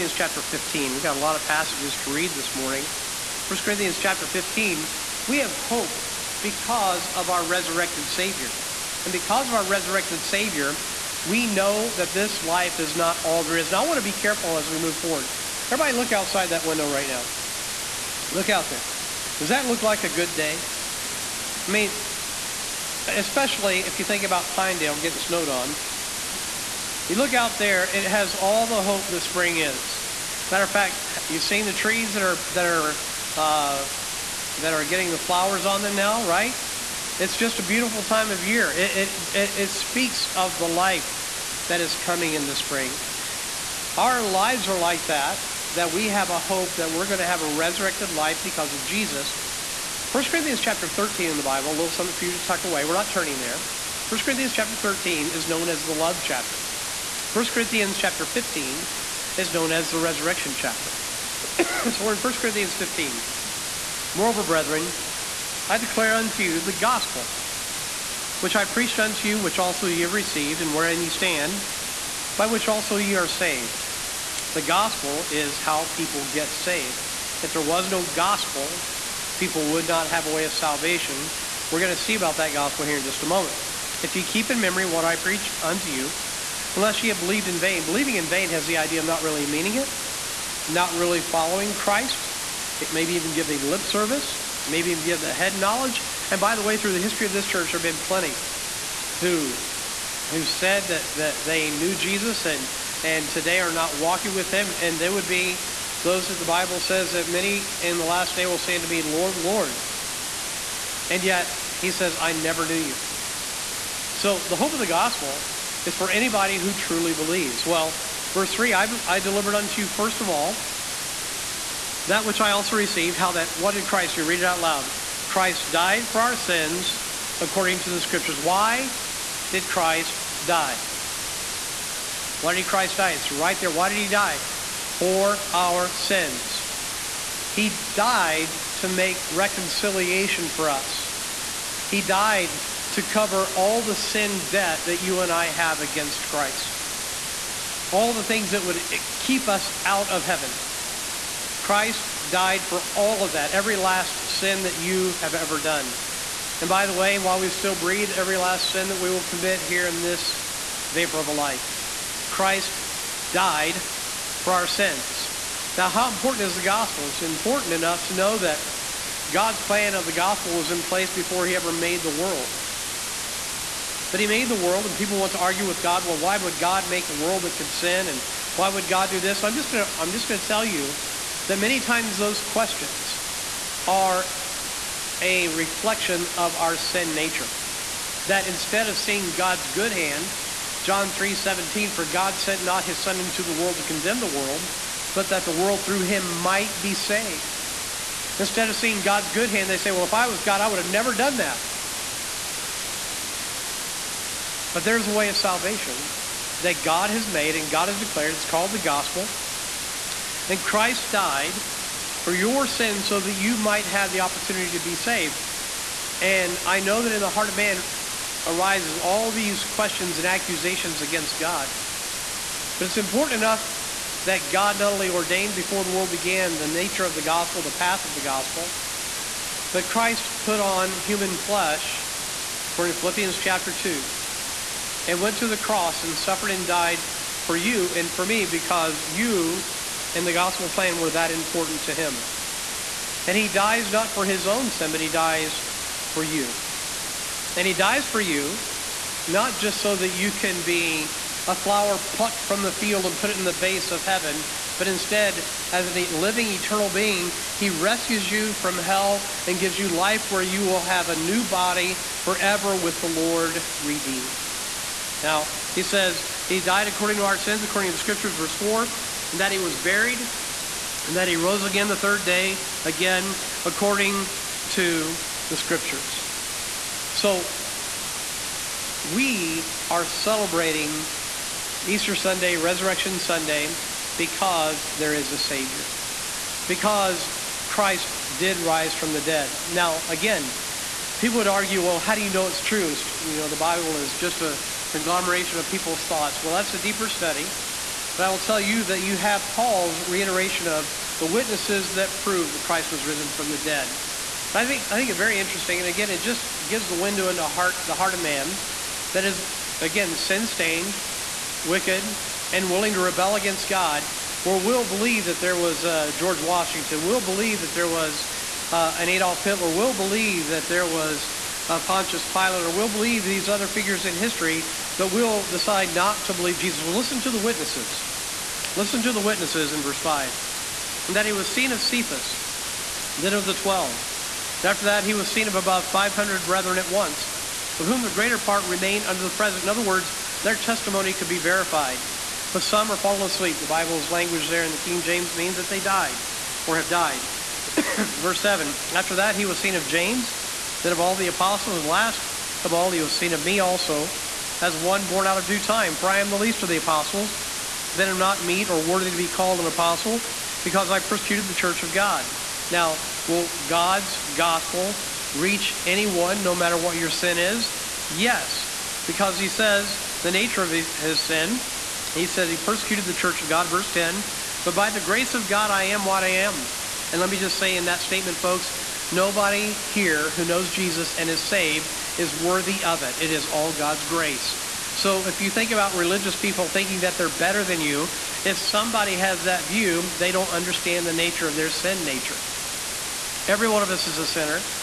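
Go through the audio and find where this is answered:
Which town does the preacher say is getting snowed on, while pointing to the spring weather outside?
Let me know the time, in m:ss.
0:24.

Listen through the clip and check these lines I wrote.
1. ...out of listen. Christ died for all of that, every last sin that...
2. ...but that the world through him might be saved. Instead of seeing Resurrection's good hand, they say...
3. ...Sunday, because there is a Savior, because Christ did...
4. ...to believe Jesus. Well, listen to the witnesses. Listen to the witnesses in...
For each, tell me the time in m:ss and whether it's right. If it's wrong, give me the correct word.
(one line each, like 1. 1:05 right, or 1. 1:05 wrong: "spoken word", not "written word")
1. 2:29 wrong: "heaven", not "listen"
2. 3:15 wrong: "God", not "Resurrection"
3. 4:43 right
4. 5:26 right.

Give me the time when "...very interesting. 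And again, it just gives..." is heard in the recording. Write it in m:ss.
5:05.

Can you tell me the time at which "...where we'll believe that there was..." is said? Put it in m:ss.
5:14.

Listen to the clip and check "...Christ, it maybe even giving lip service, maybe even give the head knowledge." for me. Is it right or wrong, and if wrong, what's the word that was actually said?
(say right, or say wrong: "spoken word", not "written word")
right.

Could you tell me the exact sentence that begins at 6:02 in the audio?
Now, Will God's gospel reach anyone, no matter what your sin is?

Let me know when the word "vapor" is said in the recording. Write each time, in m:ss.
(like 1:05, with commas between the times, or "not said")
2:40.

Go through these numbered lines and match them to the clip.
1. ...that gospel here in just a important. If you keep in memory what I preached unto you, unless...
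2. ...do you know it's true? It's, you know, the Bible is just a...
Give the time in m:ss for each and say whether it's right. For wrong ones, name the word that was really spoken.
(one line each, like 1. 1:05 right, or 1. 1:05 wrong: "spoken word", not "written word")
1. 1:22 wrong: "moment", not "important"
2. 4:52 right.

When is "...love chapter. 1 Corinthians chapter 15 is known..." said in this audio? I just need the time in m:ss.
0:55.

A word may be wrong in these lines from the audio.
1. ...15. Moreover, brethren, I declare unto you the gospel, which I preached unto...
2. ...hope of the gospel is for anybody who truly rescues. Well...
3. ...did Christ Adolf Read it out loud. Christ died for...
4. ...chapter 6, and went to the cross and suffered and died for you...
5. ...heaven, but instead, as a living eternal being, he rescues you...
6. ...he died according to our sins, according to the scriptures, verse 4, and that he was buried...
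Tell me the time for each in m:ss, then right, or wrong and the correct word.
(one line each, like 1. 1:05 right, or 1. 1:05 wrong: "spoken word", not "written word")
1. 1:02 right
2. 1:54 wrong: "believes", not "rescues"
3. 2:03 wrong: "You", not "Adolf"
4. 3:53 wrong: "2", not "6"
5. 4:14 right
6. 4:26 right.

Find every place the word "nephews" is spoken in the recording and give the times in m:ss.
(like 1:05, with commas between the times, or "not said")
not said.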